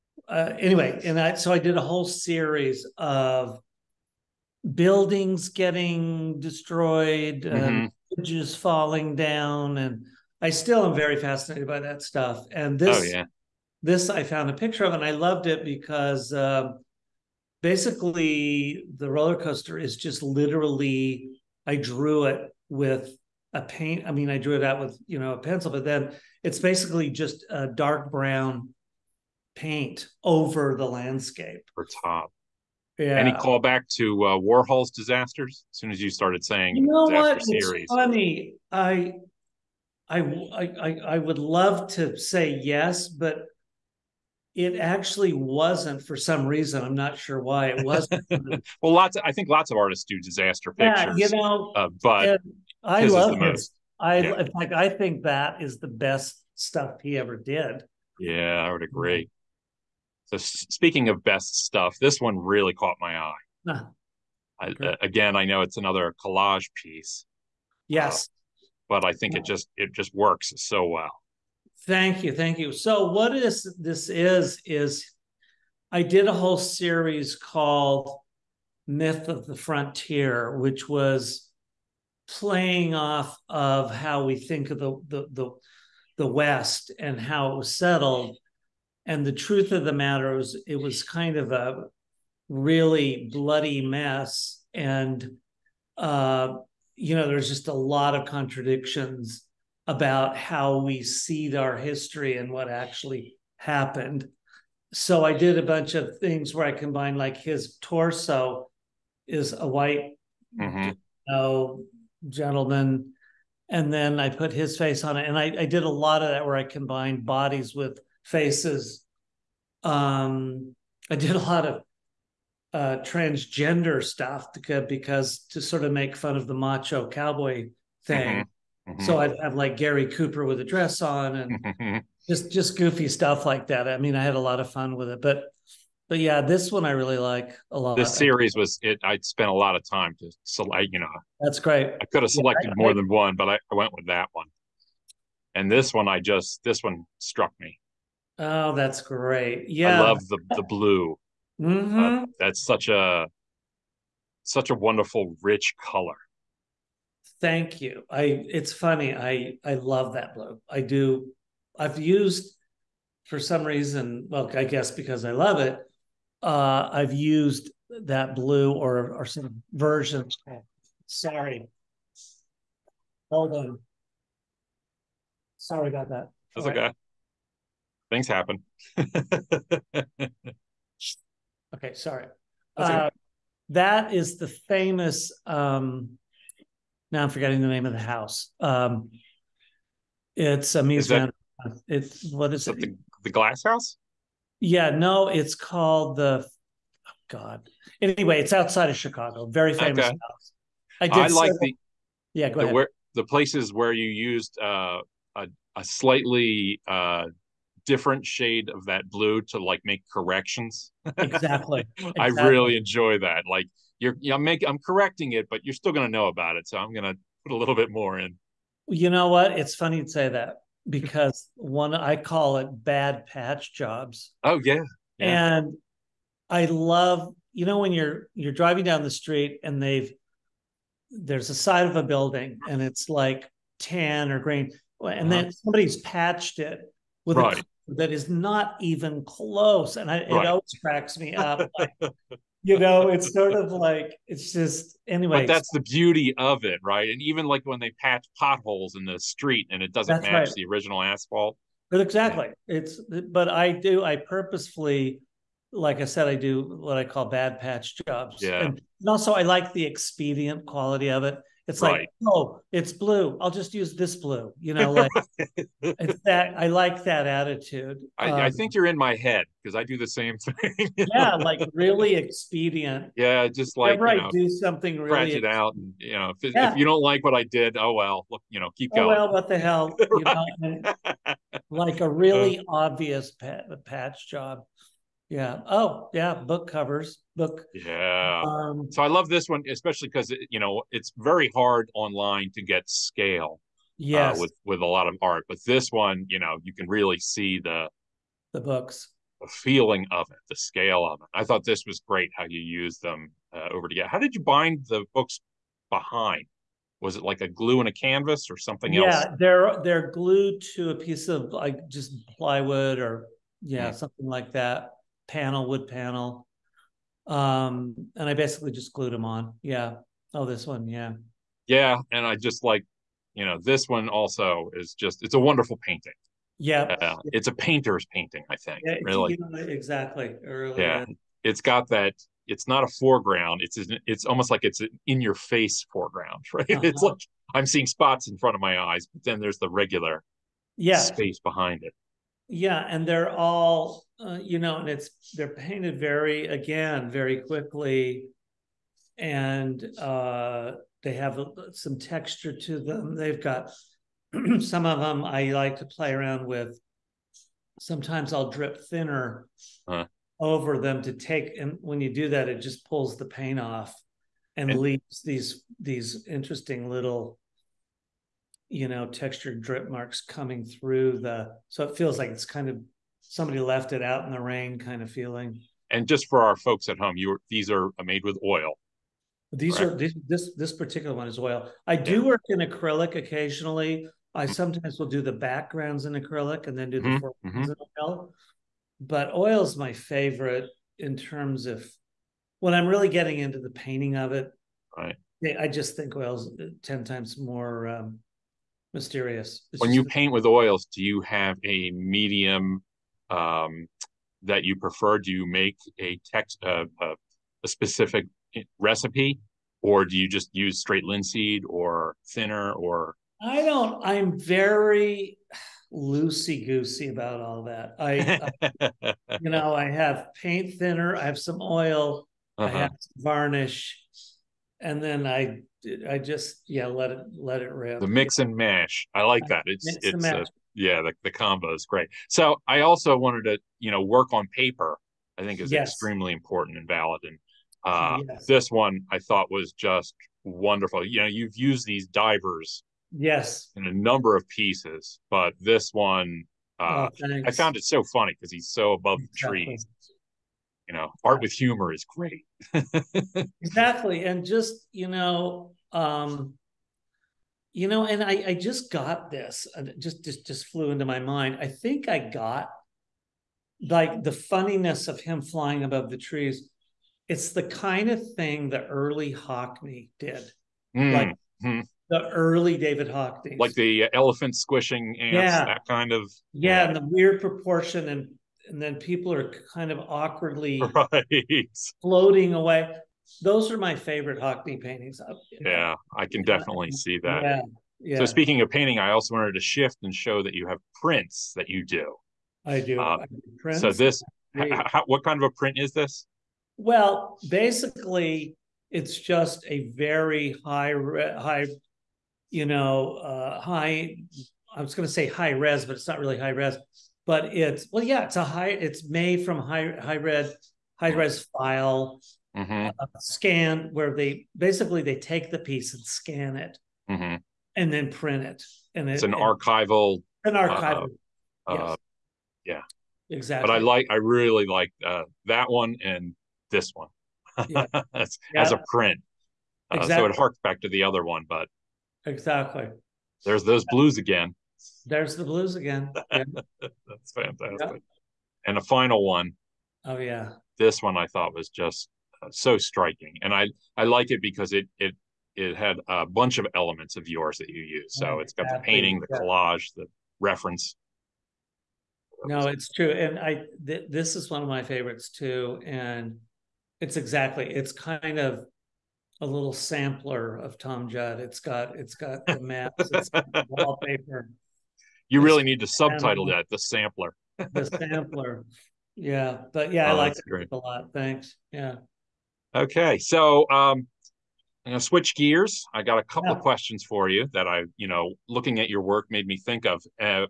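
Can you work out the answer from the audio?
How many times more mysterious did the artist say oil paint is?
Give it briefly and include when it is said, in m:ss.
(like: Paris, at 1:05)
10, at 6:36.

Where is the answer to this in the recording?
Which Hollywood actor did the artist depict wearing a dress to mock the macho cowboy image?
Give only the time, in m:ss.
2:09.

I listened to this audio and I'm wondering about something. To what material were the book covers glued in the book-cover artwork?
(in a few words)
plywood.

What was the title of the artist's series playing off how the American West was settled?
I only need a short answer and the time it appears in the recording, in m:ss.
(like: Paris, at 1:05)
Myth of the Frontier, at 1:18.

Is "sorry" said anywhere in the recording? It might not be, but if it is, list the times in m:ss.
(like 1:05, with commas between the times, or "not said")
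2:51, 2:55, 3:01.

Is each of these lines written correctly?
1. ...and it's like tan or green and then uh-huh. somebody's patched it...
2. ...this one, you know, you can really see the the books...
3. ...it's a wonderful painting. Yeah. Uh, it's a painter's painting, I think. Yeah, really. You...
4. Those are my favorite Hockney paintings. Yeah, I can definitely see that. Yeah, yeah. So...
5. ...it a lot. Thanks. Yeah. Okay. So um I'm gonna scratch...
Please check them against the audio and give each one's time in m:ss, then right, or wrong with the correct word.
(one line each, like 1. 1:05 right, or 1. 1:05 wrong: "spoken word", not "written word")
1. 3:52 right
2. 4:55 right
3. 5:25 right
4. 8:03 right
5. 9:30 wrong: "switch", not "scratch".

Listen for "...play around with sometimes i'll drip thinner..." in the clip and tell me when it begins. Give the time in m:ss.
5:55.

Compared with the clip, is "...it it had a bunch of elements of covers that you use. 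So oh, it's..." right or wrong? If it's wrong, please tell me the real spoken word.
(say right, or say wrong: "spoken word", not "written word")
wrong: "yours", not "covers".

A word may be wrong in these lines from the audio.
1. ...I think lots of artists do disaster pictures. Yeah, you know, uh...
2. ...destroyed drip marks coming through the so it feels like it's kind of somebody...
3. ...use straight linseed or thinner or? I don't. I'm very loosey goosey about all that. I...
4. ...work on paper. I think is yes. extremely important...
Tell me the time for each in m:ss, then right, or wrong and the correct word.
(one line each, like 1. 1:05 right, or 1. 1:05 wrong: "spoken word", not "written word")
1. 0:49 right
2. 6:09 wrong: "textured", not "destroyed"
3. 6:50 right
4. 7:14 right.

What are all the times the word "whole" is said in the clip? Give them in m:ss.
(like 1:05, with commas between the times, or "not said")
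0:01, 1:16.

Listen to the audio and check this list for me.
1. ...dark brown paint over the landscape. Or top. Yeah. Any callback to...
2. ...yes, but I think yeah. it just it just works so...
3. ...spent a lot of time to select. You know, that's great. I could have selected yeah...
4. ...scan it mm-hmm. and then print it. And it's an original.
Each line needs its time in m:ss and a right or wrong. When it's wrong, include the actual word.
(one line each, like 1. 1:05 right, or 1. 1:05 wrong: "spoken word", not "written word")
1. 0:27 right
2. 1:07 right
3. 2:19 right
4. 8:36 wrong: "archival", not "original".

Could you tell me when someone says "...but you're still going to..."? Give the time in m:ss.
3:35.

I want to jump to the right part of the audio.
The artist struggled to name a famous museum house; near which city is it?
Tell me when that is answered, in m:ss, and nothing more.
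3:18.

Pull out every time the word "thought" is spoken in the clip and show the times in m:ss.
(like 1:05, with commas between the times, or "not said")
5:01, 7:19, 9:01.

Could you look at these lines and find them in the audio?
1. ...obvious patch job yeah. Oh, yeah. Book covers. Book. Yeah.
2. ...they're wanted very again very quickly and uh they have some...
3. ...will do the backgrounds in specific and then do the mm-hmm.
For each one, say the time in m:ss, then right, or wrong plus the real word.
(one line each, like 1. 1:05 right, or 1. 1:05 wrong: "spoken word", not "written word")
1. 4:42 right
2. 5:45 wrong: "painted", not "wanted"
3. 6:24 wrong: "acrylic", not "specific".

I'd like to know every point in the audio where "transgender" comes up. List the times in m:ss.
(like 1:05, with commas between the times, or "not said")
2:02.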